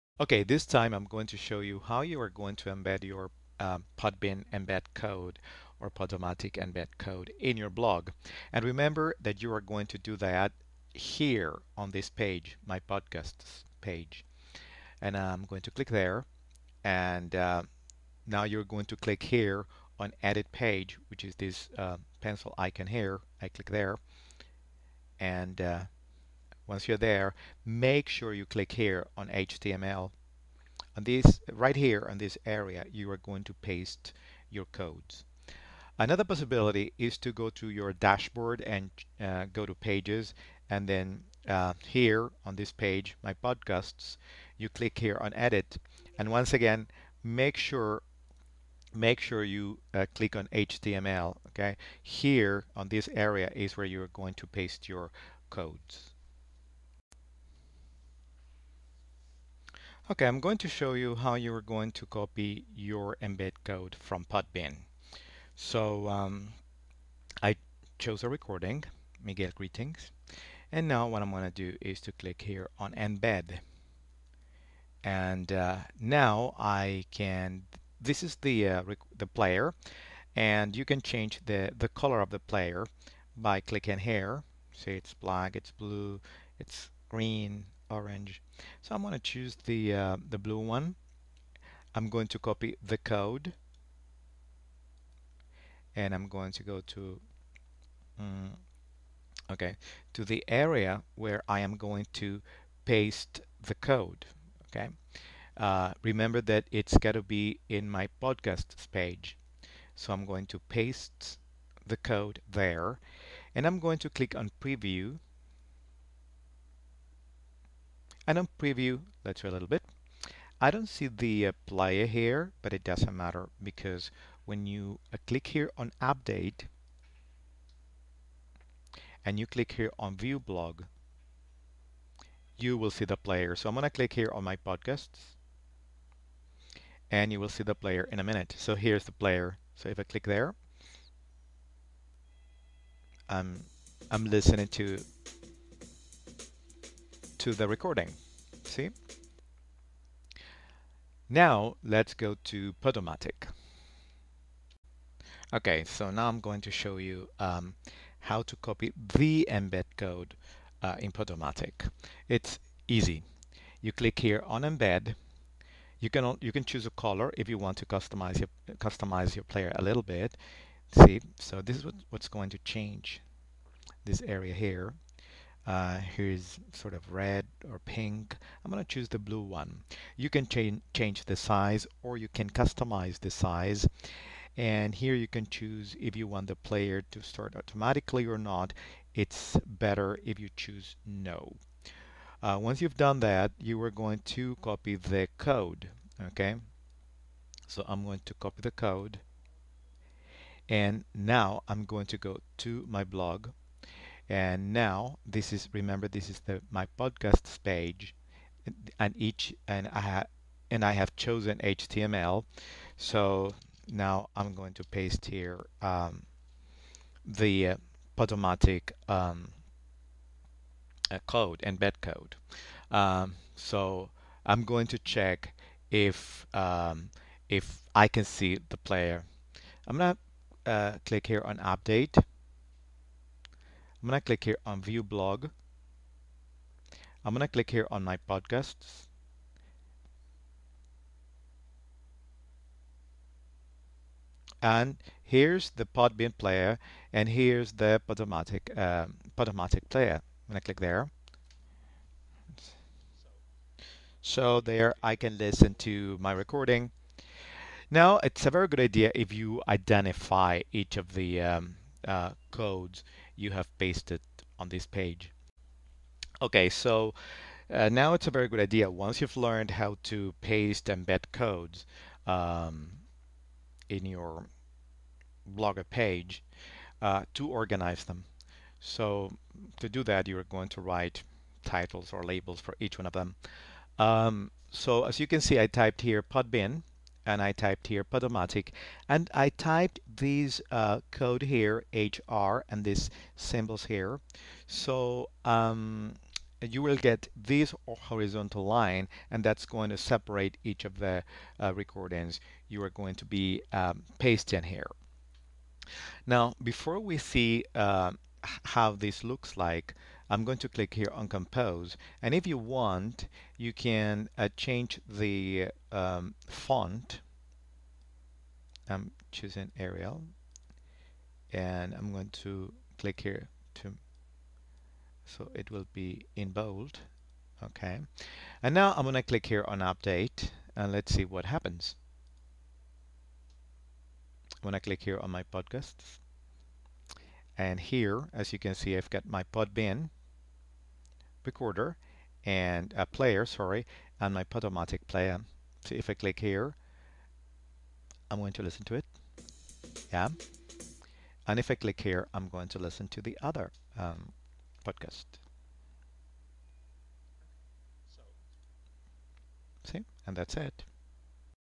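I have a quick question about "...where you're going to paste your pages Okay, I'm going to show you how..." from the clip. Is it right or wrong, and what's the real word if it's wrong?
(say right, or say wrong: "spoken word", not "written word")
wrong: "codes", not "pages".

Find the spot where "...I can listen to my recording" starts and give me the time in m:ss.
4:15.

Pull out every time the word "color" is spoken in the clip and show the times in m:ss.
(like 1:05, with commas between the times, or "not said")
1:21, 2:46.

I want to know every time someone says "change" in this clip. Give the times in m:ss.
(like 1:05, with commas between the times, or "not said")
1:20, 2:52, 3:00, 5:14.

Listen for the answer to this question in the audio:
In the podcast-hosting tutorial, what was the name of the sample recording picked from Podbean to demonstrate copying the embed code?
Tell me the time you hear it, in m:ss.
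1:09.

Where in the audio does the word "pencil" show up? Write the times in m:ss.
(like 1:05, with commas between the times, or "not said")
0:22.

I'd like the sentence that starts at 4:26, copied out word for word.
Okay, so uh, now it's a very good idea.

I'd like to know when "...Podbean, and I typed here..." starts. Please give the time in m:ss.
4:46.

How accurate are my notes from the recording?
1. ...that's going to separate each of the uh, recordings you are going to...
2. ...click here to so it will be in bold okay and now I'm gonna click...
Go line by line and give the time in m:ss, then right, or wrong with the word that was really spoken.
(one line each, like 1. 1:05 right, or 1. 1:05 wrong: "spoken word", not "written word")
1. 4:59 right
2. 5:22 right.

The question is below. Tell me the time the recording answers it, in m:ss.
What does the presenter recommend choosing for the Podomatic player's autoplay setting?
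3:09.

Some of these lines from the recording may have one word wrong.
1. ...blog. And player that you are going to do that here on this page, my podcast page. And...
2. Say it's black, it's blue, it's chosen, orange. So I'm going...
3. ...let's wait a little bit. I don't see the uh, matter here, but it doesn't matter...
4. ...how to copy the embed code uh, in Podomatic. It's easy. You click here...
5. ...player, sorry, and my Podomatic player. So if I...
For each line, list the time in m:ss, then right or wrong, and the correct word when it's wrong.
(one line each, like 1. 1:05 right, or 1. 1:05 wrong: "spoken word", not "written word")
1. 0:07 wrong: "remember", not "player"
2. 1:24 wrong: "green", not "chosen"
3. 1:59 wrong: "player", not "matter"
4. 2:38 right
5. 5:43 right.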